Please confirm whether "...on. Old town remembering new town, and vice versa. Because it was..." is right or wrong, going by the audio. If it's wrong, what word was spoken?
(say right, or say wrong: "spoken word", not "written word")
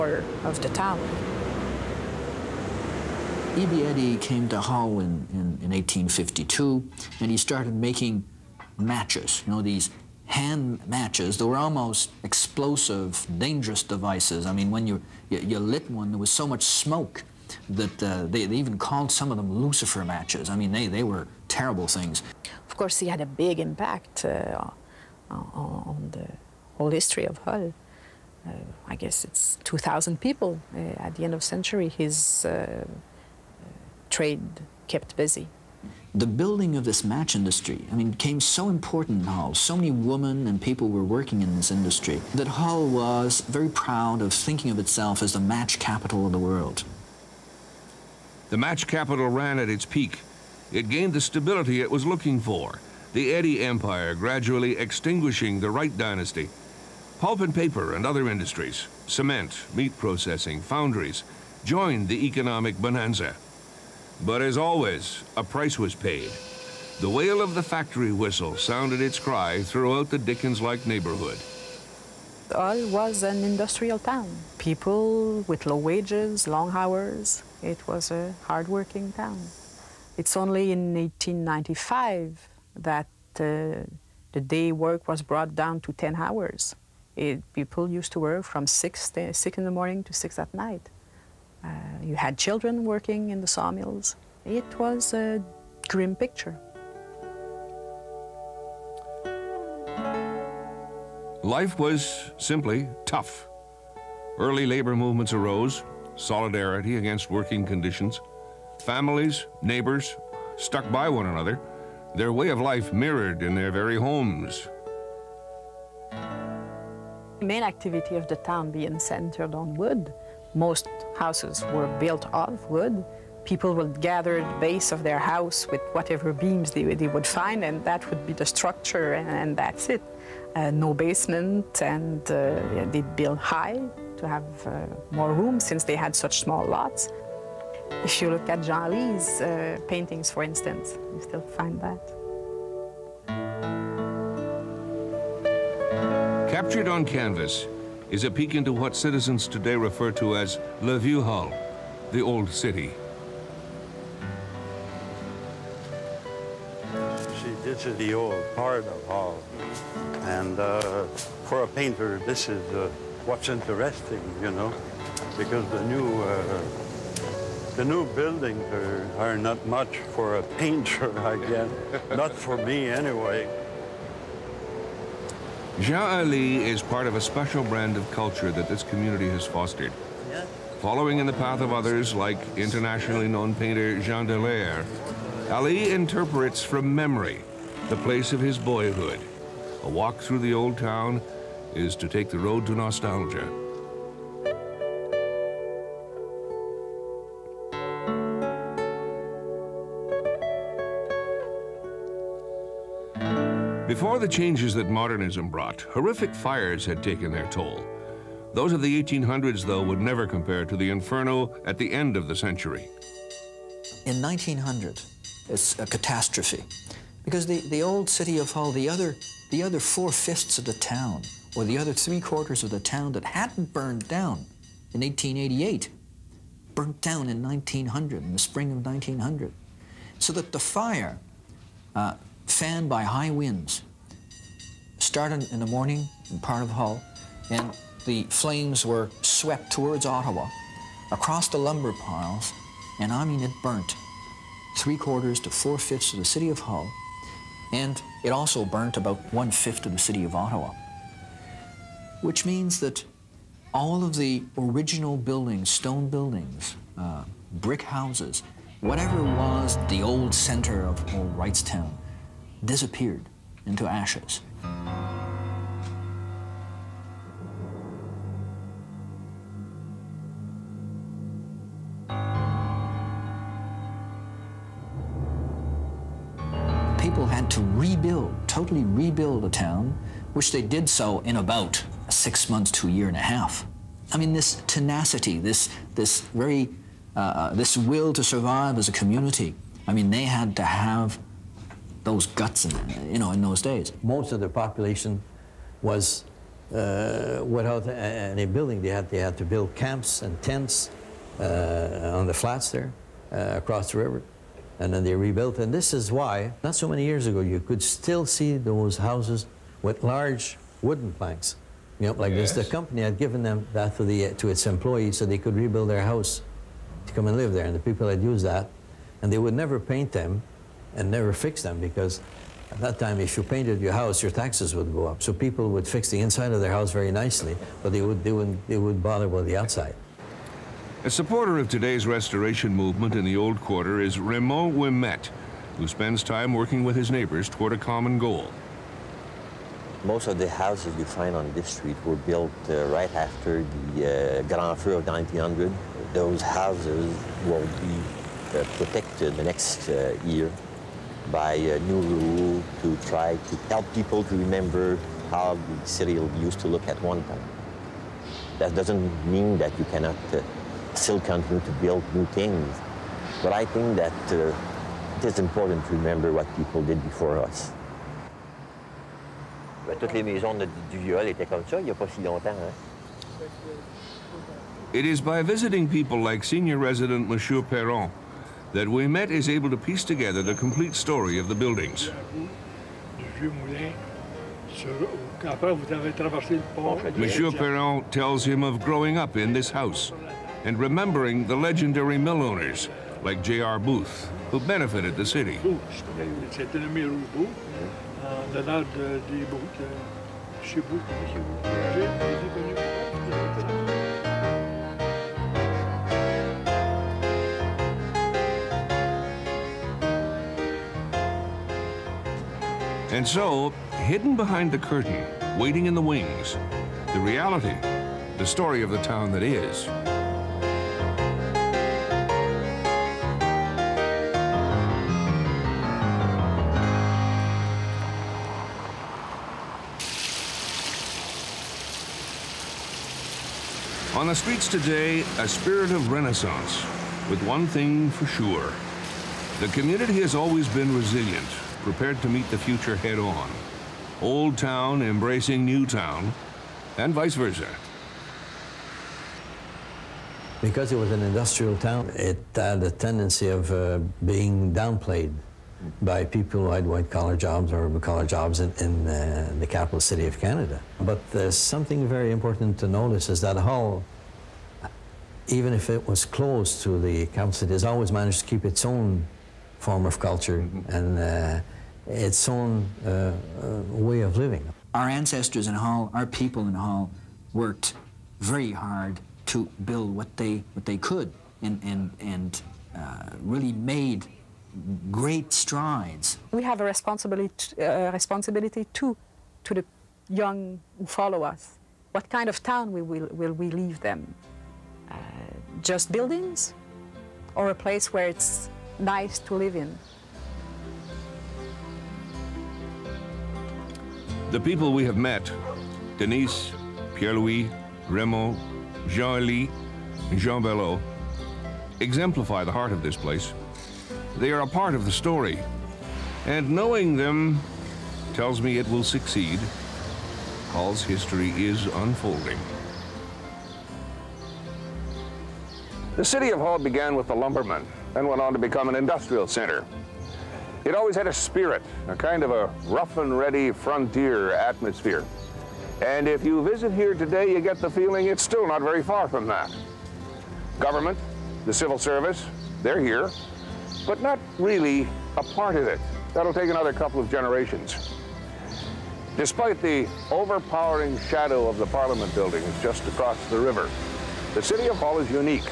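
wrong: "embracing", not "remembering".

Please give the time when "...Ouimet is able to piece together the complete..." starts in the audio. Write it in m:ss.
6:18.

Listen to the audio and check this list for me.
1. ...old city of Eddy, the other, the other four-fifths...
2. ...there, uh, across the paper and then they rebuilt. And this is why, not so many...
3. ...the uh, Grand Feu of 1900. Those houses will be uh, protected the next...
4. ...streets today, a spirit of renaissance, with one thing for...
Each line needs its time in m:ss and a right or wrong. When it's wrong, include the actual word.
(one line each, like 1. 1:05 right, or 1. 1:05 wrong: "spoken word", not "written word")
1. 3:37 wrong: "Hull", not "Eddy"
2. 5:02 wrong: "river", not "paper"
3. 5:43 right
4. 7:14 right.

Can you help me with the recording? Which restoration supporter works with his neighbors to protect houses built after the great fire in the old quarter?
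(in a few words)
Raymond Ouimet.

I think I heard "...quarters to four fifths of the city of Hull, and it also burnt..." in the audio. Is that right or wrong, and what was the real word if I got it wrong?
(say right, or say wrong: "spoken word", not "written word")
right.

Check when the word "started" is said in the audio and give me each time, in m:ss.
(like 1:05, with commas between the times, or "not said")
0:07, 3:54.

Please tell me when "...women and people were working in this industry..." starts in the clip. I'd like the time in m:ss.
0:39.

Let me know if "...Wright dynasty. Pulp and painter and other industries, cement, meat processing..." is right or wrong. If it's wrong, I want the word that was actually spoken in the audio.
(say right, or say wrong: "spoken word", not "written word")
wrong: "paper", not "painter".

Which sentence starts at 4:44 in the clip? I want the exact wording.
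I mean, this tenacity, this, this very, uh, uh, this will to survive as a community.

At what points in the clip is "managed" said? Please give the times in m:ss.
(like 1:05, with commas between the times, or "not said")
7:48.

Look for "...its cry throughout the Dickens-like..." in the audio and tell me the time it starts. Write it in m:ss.
1:09.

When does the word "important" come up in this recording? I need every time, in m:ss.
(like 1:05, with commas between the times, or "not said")
0:38, 6:05, 7:42.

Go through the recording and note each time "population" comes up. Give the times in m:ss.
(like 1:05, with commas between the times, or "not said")
4:54.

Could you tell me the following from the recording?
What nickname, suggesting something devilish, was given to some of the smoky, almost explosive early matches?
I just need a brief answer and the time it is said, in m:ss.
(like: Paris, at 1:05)
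Lucifer matches, at 0:19.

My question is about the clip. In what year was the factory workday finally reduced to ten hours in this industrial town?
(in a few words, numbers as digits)
1895.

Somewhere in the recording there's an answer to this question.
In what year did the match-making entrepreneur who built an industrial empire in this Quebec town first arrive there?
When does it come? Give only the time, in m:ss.
0:05.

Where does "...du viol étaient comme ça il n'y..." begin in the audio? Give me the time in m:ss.
6:10.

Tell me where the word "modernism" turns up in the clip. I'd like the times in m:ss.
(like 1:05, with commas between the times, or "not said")
3:24.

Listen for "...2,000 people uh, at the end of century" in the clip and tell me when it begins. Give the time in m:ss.
0:29.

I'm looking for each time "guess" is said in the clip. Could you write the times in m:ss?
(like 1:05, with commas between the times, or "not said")
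0:28, 2:51.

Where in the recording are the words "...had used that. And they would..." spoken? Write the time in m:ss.
5:18.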